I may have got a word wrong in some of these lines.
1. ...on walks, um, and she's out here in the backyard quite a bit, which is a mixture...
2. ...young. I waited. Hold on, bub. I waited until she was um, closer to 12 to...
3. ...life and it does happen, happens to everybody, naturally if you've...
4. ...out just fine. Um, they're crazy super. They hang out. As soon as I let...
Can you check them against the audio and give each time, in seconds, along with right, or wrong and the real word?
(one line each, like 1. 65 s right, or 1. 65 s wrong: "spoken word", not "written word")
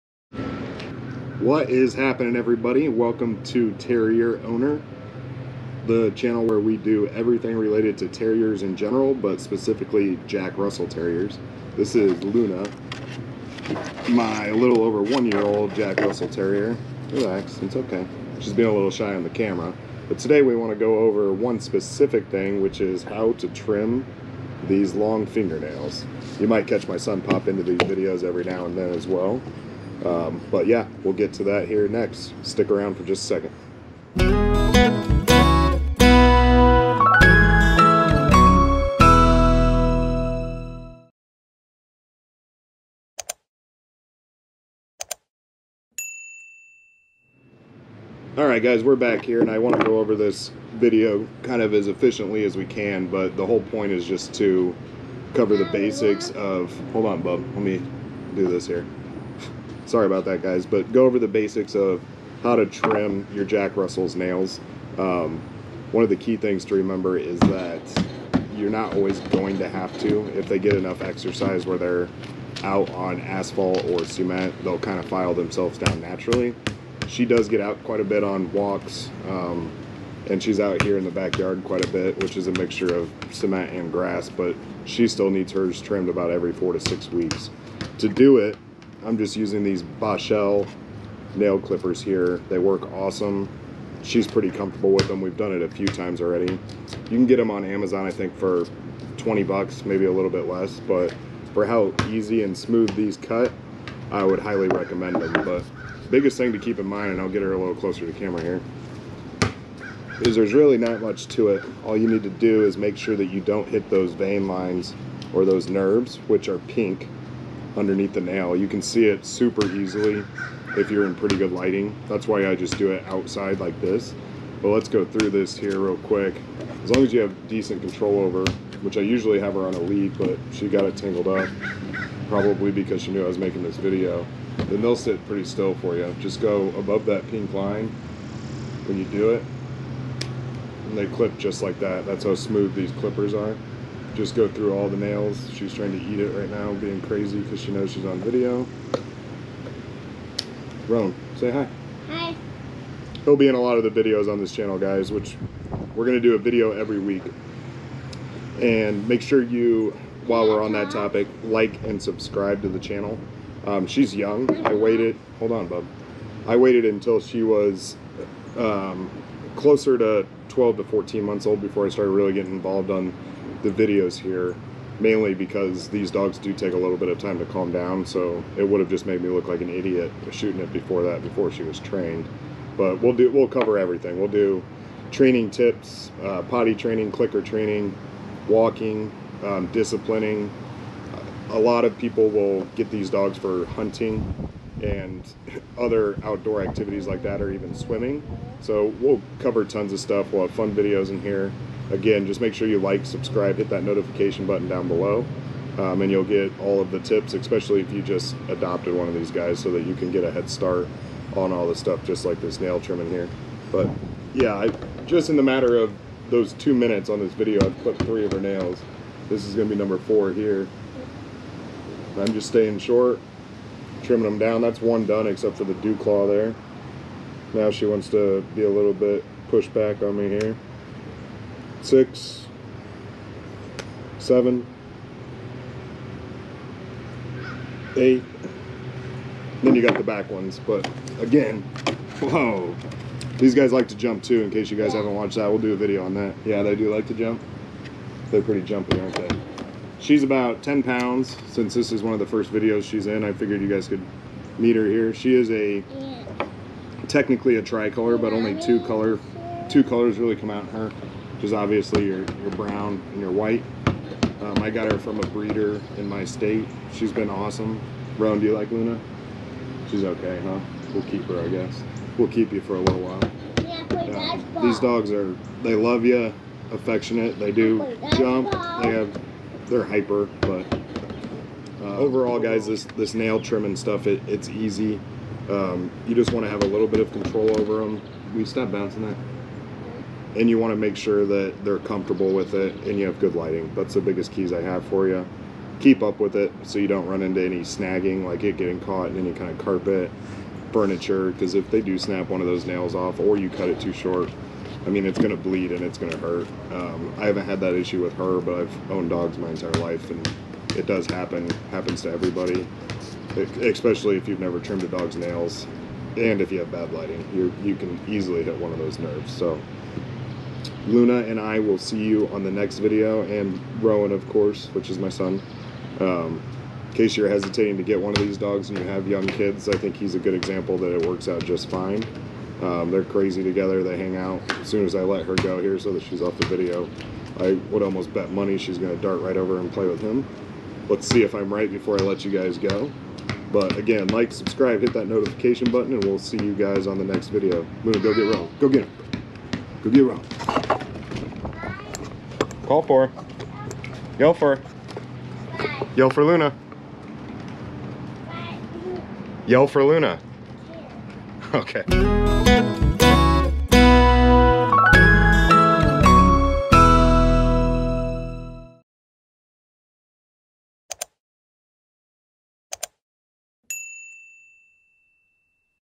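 1. 78 s right
2. 164 s right
3. 309 s wrong: "especially", not "naturally"
4. 331 s wrong: "together", not "super".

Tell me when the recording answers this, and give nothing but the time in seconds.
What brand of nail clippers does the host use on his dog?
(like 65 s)
89 s.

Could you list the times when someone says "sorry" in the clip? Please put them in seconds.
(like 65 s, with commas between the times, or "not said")
59 s.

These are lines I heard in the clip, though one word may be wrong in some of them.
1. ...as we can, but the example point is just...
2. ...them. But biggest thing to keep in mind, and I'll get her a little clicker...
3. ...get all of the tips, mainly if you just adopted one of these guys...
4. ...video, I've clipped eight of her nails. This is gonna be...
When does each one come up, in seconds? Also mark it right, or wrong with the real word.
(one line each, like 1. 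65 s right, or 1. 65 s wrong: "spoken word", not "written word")
1. 52 s wrong: "whole", not "example"
2. 105 s wrong: "closer", not "clicker"
3. 206 s wrong: "especially", not "mainly"
4. 217 s wrong: "three", not "eight".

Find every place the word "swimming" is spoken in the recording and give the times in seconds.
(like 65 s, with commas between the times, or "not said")
197 s.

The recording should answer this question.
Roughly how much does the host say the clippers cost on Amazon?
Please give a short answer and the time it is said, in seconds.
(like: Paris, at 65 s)
20 bucks, at 99 s.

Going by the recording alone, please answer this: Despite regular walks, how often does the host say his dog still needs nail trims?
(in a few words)
4 to 6 weeks.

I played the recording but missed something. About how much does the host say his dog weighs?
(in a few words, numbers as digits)
10 pounds.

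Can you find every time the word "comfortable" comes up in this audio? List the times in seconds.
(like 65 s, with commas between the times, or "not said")
94 s, 291 s.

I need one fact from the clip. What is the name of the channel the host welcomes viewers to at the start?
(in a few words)
Terrier Owner.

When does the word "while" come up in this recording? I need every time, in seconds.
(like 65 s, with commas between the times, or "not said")
160 s, 272 s.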